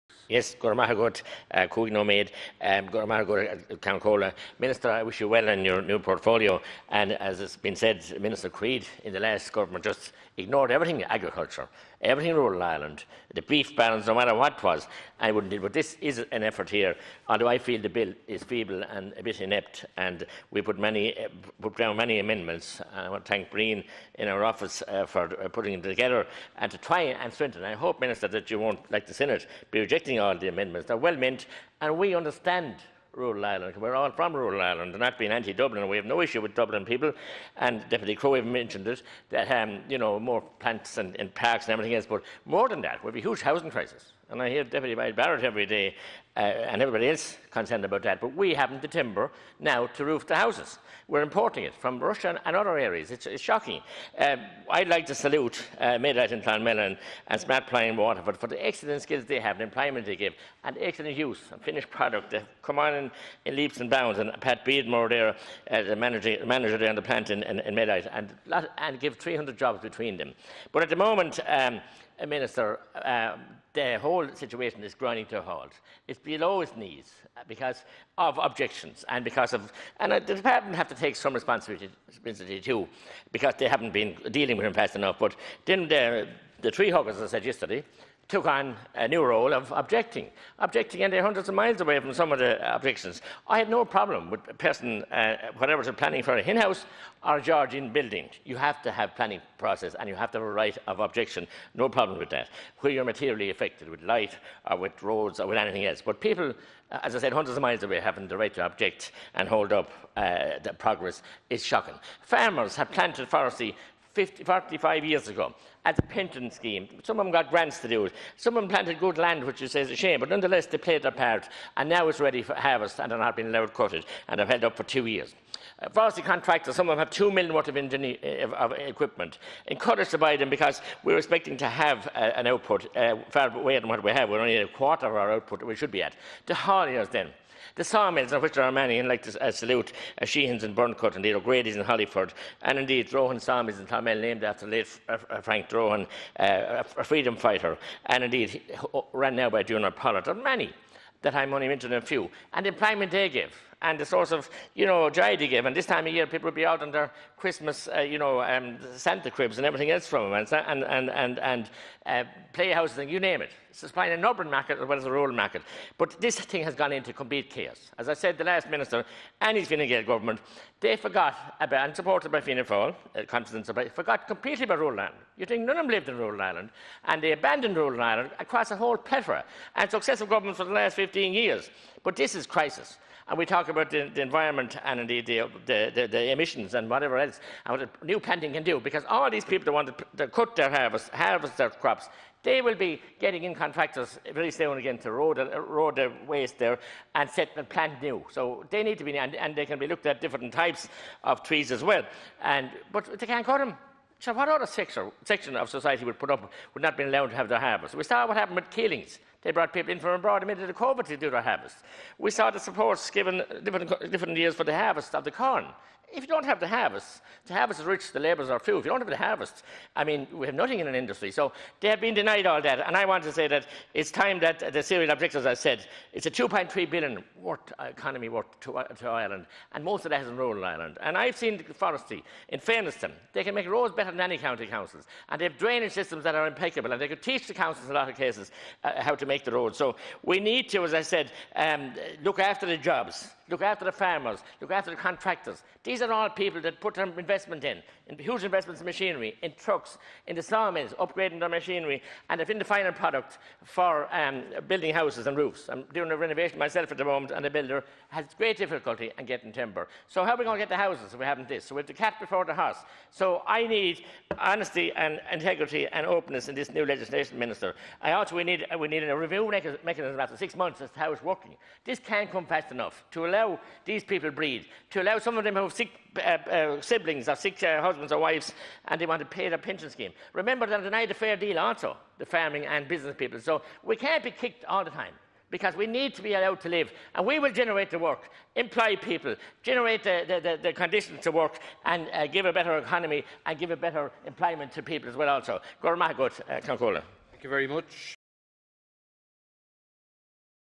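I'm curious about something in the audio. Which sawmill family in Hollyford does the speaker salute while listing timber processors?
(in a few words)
O'Grady's.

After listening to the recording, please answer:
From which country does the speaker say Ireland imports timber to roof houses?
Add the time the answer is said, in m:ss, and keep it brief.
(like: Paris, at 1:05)
Russia, at 0:51.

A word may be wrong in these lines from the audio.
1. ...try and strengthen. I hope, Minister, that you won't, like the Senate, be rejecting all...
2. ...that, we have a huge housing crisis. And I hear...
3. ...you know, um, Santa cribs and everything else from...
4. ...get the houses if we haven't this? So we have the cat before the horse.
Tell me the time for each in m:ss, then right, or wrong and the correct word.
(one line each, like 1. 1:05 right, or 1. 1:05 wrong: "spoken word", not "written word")
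1. 0:26 right
2. 0:42 right
3. 2:38 right
4. 4:20 right.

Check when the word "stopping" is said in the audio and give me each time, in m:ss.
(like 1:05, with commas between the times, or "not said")
not said.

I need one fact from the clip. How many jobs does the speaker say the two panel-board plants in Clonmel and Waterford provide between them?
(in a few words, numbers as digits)
300.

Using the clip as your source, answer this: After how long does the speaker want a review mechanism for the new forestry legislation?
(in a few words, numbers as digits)
6 months.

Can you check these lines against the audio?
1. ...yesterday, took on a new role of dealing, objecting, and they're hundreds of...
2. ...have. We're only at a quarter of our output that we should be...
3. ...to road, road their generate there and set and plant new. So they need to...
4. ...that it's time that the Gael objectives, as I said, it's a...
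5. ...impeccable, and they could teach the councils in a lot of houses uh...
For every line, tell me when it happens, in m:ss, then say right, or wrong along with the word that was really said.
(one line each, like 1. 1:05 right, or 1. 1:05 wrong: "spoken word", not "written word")
1. 1:27 wrong: "objecting", not "dealing"
2. 2:14 right
3. 3:14 wrong: "waste", not "generate"
4. 3:43 wrong: "Syrian", not "Gael"
5. 3:56 wrong: "cases", not "houses".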